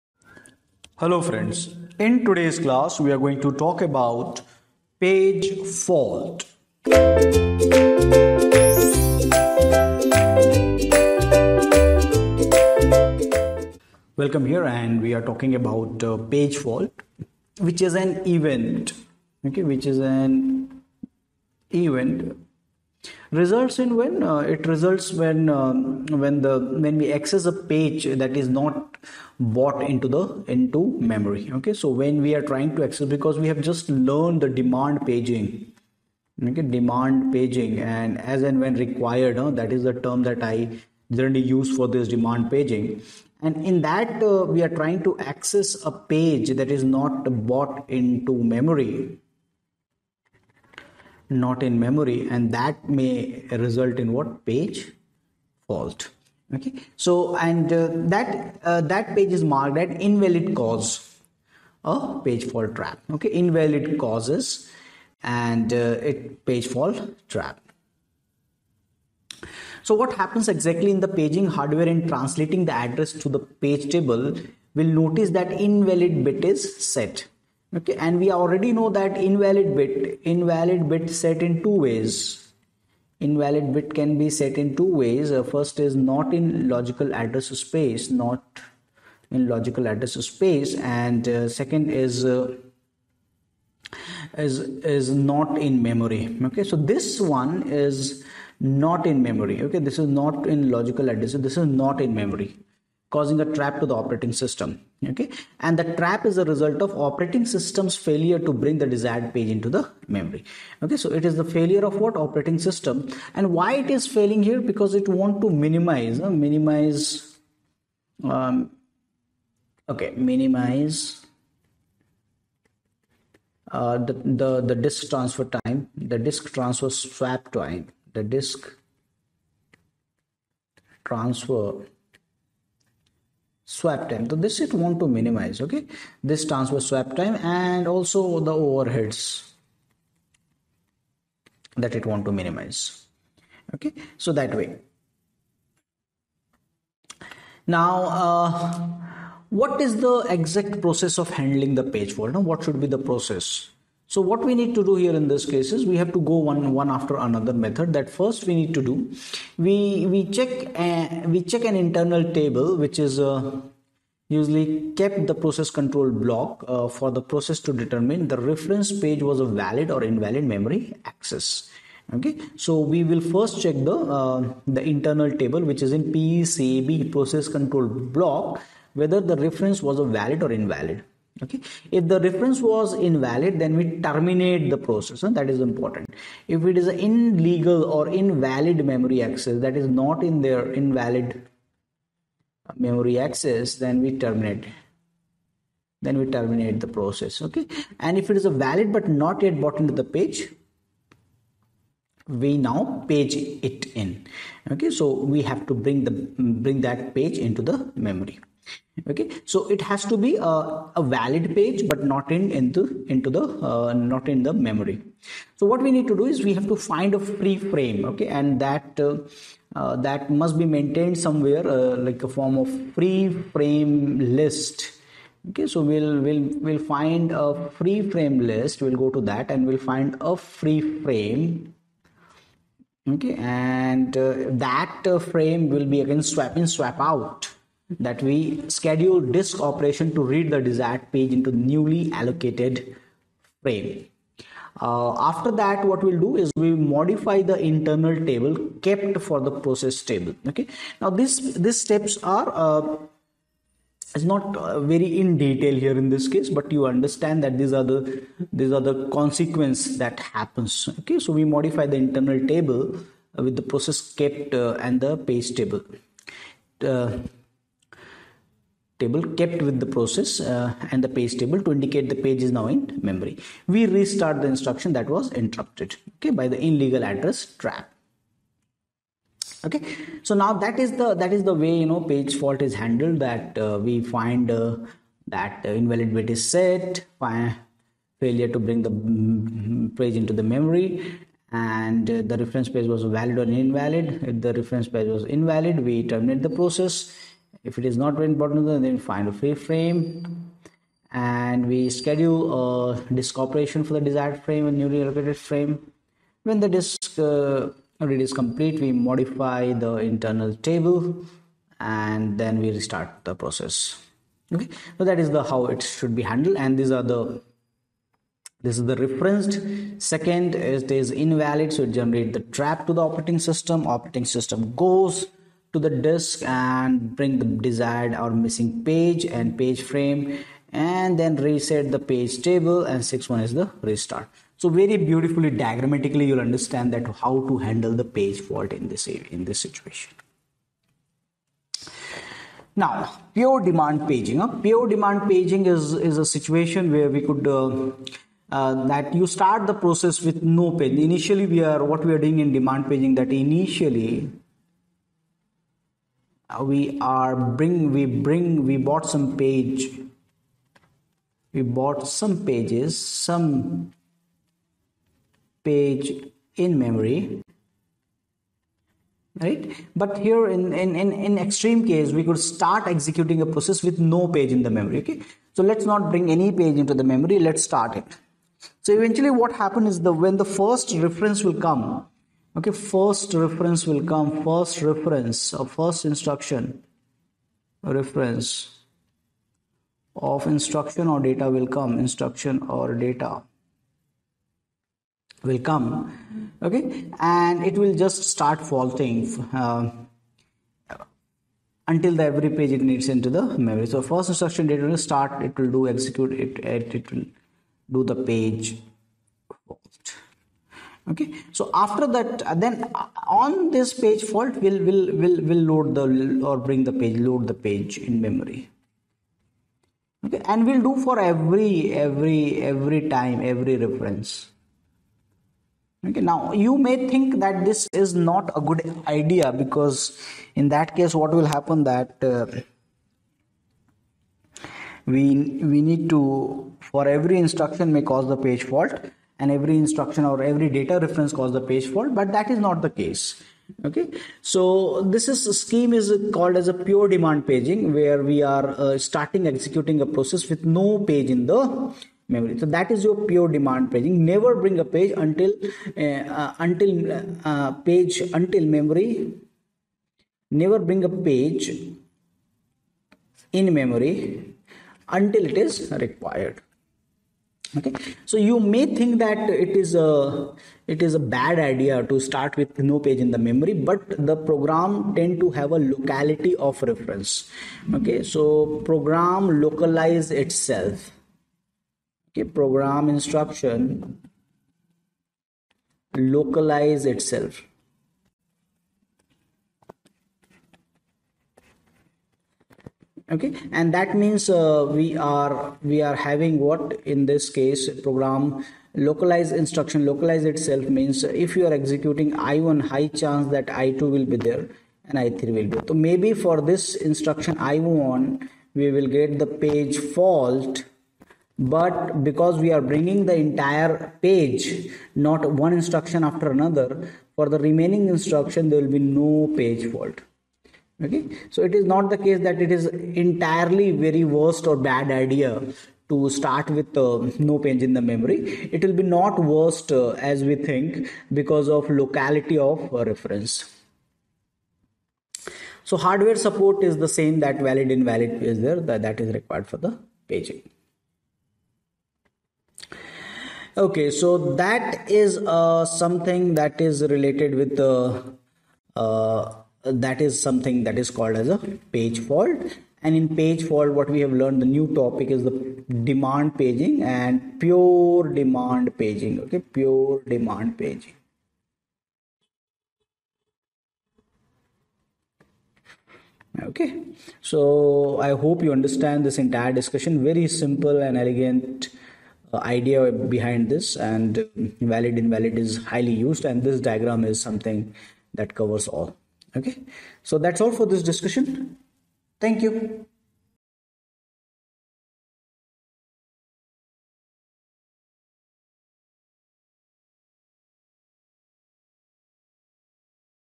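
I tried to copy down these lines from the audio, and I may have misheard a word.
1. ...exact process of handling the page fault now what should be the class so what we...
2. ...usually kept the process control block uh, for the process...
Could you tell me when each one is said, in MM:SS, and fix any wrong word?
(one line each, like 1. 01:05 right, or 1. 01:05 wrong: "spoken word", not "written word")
1. 02:30 wrong: "process", not "class"
2. 02:44 right.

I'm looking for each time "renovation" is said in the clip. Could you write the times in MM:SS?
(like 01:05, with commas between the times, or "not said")
not said.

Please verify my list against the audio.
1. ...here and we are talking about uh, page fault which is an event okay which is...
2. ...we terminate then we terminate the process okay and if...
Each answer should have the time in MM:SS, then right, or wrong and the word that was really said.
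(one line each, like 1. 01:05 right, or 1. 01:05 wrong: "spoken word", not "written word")
1. 00:14 right
2. 03:14 right.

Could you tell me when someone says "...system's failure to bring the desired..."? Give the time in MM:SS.
01:47.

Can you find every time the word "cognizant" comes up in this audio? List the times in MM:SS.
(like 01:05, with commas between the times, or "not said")
not said.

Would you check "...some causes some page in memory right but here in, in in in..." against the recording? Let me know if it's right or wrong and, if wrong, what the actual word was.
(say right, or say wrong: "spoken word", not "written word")
wrong: "pages", not "causes".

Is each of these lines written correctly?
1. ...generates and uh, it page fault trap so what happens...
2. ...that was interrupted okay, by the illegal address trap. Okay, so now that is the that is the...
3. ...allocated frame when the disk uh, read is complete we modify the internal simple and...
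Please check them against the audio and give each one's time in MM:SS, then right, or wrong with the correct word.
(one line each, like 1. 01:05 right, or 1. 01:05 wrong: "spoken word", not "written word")
1. 01:03 wrong: "causes", not "generates"
2. 04:34 right
3. 05:05 wrong: "table", not "simple".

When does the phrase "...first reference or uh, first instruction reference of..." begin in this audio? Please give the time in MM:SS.
06:24.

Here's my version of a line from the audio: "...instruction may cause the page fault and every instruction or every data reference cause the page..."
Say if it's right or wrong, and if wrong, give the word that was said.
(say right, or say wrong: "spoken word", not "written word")
right.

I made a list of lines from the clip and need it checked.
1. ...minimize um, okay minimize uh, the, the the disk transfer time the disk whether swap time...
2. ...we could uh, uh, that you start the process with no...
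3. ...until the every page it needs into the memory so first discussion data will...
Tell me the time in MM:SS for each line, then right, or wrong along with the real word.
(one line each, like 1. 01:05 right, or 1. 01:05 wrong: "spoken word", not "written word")
1. 01:56 wrong: "transfer", not "whether"
2. 05:47 right
3. 06:41 wrong: "instruction", not "discussion".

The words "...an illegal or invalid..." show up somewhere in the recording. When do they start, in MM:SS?
03:06.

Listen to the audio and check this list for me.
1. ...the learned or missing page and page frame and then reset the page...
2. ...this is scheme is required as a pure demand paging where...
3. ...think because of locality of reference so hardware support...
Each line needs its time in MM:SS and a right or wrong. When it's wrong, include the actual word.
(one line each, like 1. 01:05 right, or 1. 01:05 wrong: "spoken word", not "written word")
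1. 05:27 wrong: "desired", not "learned"
2. 07:25 wrong: "called", not "required"
3. 08:50 right.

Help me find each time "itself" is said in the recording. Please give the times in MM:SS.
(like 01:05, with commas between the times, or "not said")
08:00, 08:07, 08:20.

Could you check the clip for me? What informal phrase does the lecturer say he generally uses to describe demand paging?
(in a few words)
As and when required.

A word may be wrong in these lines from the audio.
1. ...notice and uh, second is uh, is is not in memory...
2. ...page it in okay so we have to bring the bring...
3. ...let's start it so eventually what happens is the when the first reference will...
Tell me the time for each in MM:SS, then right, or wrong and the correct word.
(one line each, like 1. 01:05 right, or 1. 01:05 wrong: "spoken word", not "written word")
1. 01:30 wrong: "space", not "notice"
2. 03:23 right
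3. 06:17 right.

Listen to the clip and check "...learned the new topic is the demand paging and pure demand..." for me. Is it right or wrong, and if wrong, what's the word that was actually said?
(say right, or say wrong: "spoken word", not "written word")
right.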